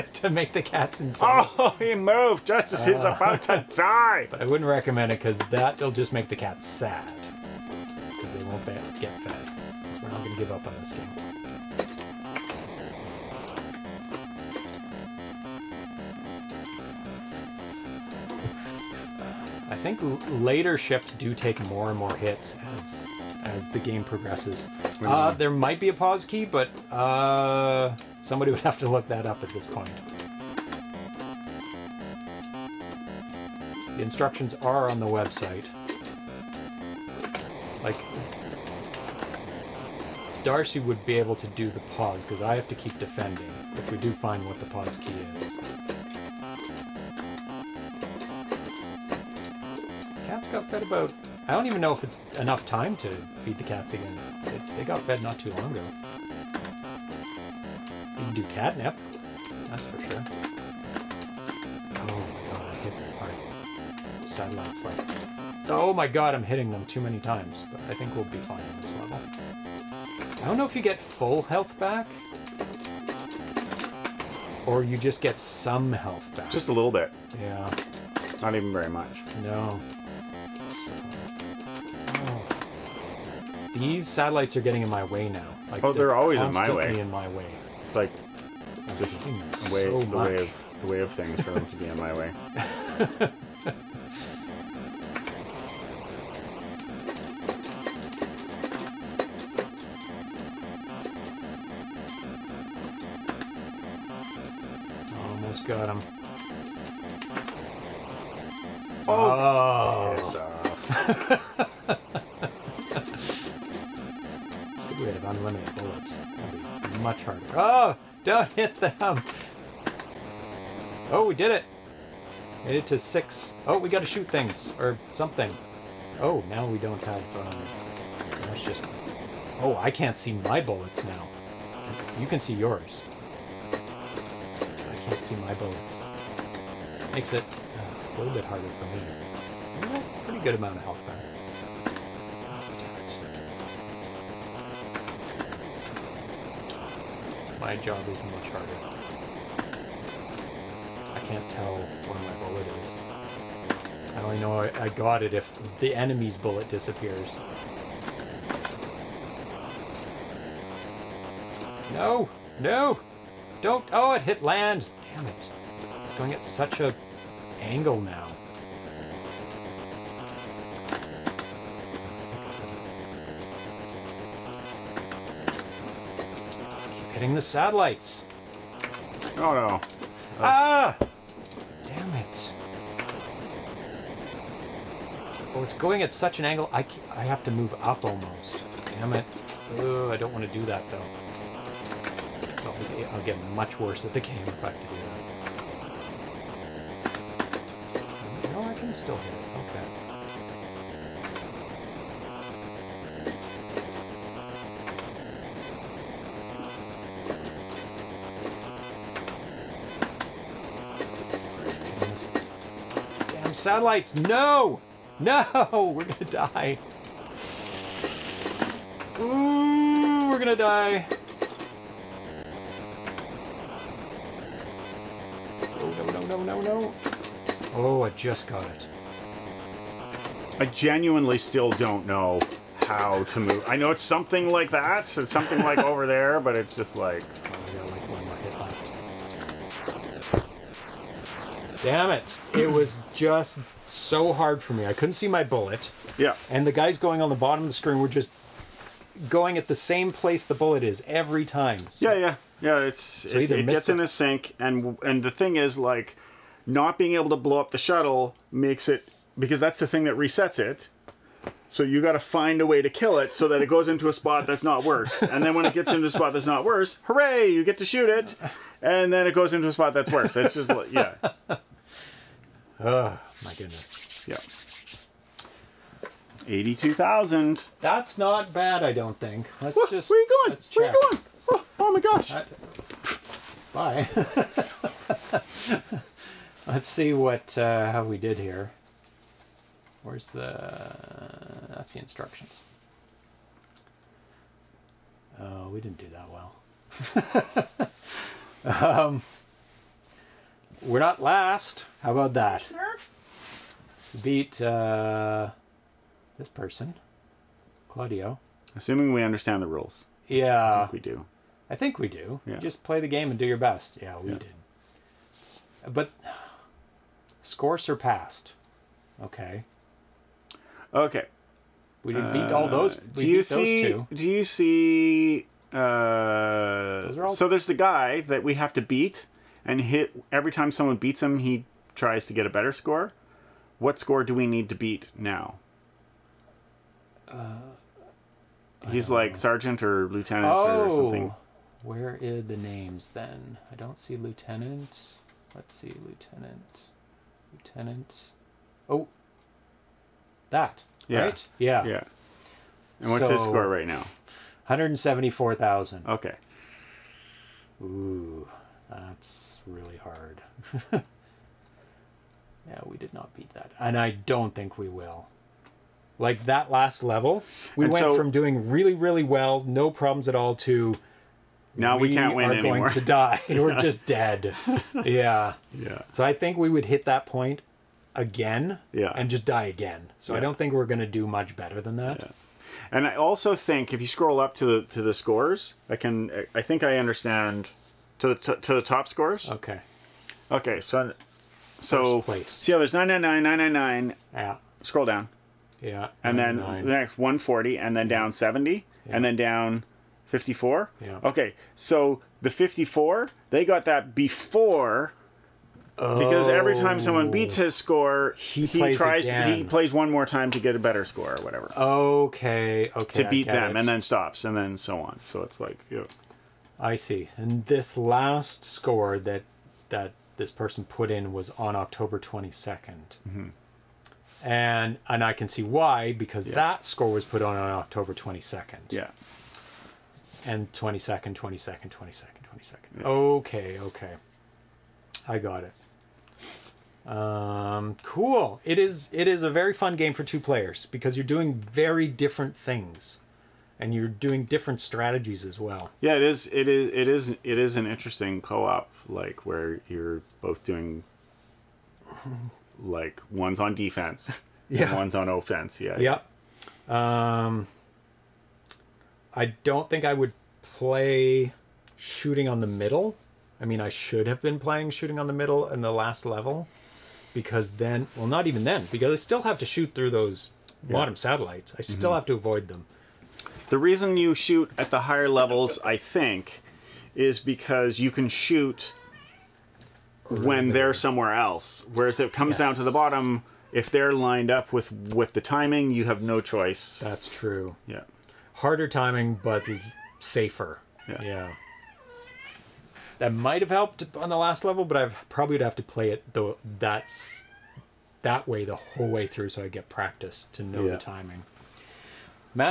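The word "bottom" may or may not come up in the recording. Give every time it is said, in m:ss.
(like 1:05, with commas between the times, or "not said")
4:07, 7:50, 8:02.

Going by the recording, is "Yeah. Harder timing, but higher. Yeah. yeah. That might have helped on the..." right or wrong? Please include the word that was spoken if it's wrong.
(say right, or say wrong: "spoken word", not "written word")
wrong: "safer", not "higher".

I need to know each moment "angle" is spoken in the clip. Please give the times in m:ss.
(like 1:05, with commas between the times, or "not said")
2:47, 3:06.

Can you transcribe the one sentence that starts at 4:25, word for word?
And then when it gets into a spot that's not worse, hooray, you get to shoot it.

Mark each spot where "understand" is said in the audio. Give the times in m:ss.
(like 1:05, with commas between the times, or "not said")
5:09, 6:26.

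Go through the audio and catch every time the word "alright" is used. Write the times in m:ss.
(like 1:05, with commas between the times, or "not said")
not said.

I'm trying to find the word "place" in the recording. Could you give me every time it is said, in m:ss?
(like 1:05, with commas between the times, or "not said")
4:10, 6:32.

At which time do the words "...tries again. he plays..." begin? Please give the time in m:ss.
6:48.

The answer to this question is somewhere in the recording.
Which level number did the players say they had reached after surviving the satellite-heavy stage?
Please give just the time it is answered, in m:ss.
2:02.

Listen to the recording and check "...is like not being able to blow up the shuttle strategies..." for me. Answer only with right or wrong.
wrong.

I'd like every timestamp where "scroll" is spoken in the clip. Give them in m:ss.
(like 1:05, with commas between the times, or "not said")
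6:24, 6:34.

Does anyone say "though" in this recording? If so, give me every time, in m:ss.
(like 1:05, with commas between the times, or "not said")
3:10, 8:16.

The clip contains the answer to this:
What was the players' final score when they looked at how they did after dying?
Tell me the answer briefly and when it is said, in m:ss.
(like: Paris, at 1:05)
82,000, at 4:36.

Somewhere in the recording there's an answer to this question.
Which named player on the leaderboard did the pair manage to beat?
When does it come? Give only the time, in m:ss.
5:07.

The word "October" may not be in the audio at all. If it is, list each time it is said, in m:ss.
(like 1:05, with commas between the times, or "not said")
7:01, 7:07.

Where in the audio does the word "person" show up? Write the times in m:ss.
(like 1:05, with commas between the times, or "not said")
5:06, 7:00.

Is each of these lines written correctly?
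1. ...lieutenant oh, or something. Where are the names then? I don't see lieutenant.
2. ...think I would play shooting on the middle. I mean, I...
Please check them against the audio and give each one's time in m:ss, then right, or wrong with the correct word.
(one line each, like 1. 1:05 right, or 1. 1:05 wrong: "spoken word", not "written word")
1. 5:40 right
2. 7:39 right.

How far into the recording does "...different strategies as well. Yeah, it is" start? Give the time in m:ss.
7:24.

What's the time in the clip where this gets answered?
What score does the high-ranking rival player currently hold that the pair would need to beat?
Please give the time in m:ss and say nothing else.
5:54.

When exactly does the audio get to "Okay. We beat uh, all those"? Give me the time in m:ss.
5:20.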